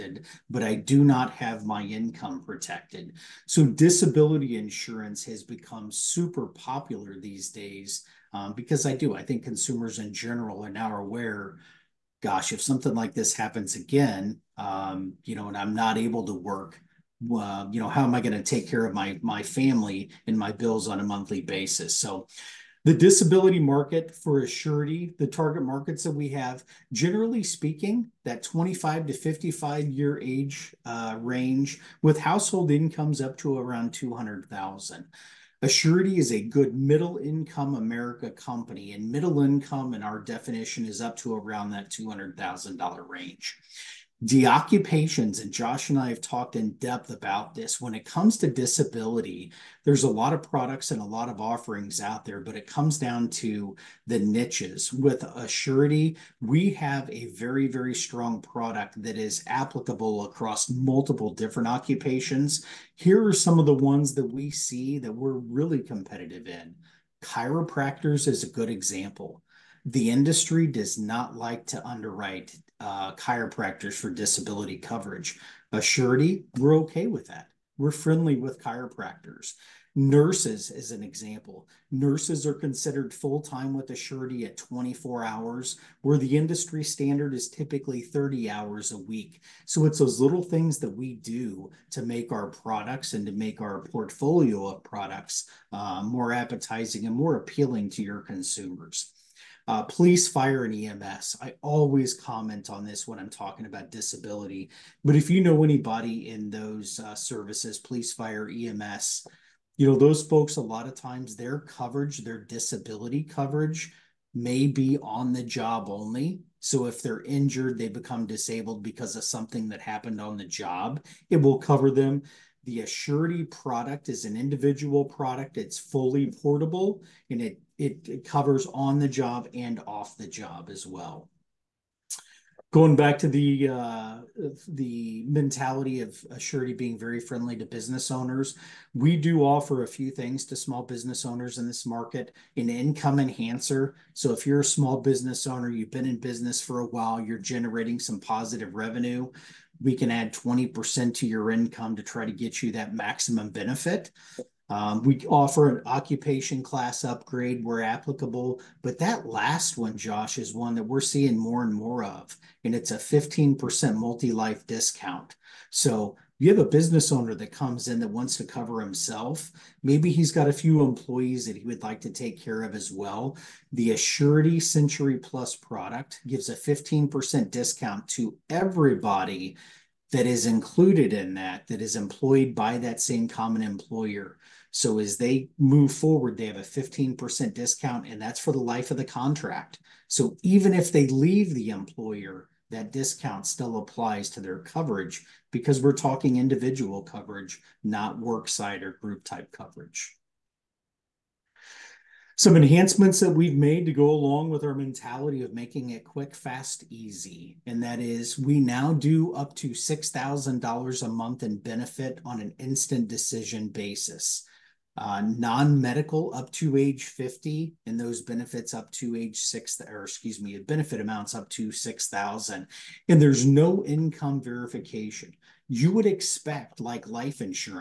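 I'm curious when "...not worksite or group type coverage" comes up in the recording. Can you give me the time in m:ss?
3:17.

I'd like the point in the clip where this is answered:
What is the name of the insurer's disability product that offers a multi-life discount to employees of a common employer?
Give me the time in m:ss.
2:54.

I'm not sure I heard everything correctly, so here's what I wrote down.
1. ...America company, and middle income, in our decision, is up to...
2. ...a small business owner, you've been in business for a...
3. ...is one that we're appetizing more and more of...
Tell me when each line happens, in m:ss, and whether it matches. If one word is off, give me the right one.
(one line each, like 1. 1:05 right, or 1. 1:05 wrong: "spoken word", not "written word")
1. 0:37 wrong: "definition", not "decision"
2. 2:24 right
3. 2:40 wrong: "seeing", not "appetizing".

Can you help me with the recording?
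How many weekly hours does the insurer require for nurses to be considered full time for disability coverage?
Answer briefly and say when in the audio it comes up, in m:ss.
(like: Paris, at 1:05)
24 hours, at 1:24.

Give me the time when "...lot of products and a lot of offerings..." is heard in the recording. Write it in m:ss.
0:50.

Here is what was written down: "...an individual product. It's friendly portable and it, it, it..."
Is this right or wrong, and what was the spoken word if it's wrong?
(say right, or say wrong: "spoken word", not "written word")
wrong: "fully", not "friendly".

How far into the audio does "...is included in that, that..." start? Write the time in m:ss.
3:00.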